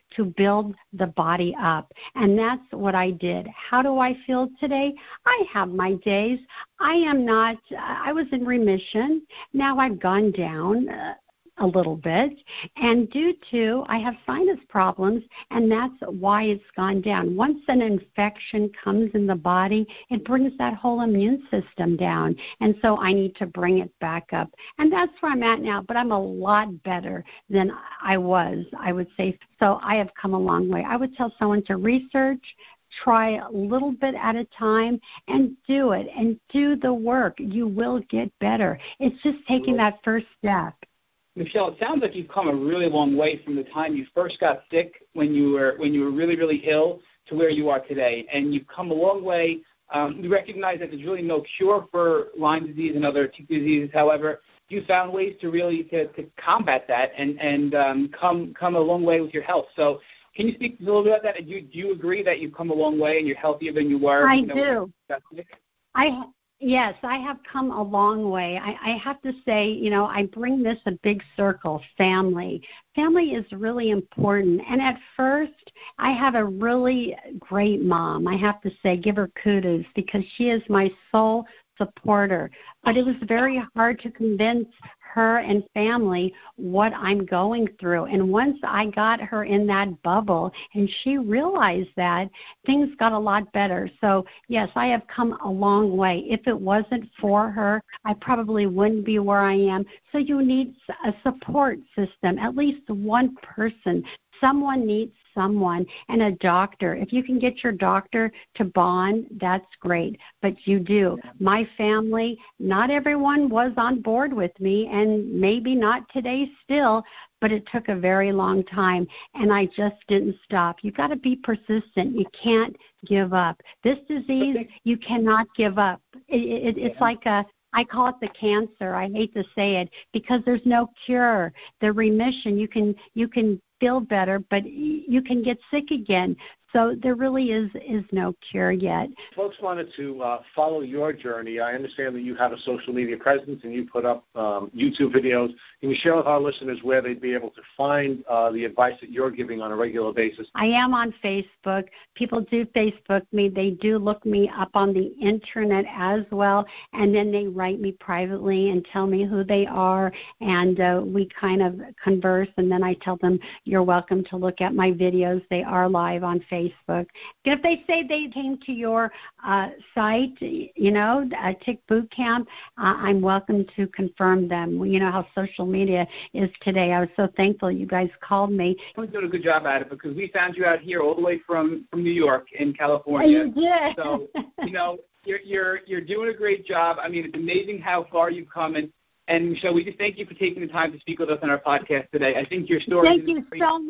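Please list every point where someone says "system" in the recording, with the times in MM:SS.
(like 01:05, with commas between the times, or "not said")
00:21, 01:41.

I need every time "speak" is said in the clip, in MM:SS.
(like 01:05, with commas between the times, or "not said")
01:00, 03:11.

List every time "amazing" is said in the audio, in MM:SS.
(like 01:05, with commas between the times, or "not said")
03:07.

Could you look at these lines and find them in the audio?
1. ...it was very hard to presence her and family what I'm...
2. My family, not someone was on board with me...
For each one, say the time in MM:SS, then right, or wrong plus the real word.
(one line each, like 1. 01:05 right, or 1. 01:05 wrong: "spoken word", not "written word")
1. 01:22 wrong: "convince", not "presence"
2. 01:51 wrong: "everyone", not "someone".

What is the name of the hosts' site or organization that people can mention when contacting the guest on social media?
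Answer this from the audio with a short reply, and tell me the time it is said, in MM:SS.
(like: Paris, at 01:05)
Tick Boot Camp, at 02:51.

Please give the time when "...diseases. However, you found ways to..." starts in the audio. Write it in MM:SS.
00:53.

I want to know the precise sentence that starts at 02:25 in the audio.
Can you share with our listeners where they'd be able to find uh, the advice that you're giving on a regular basis?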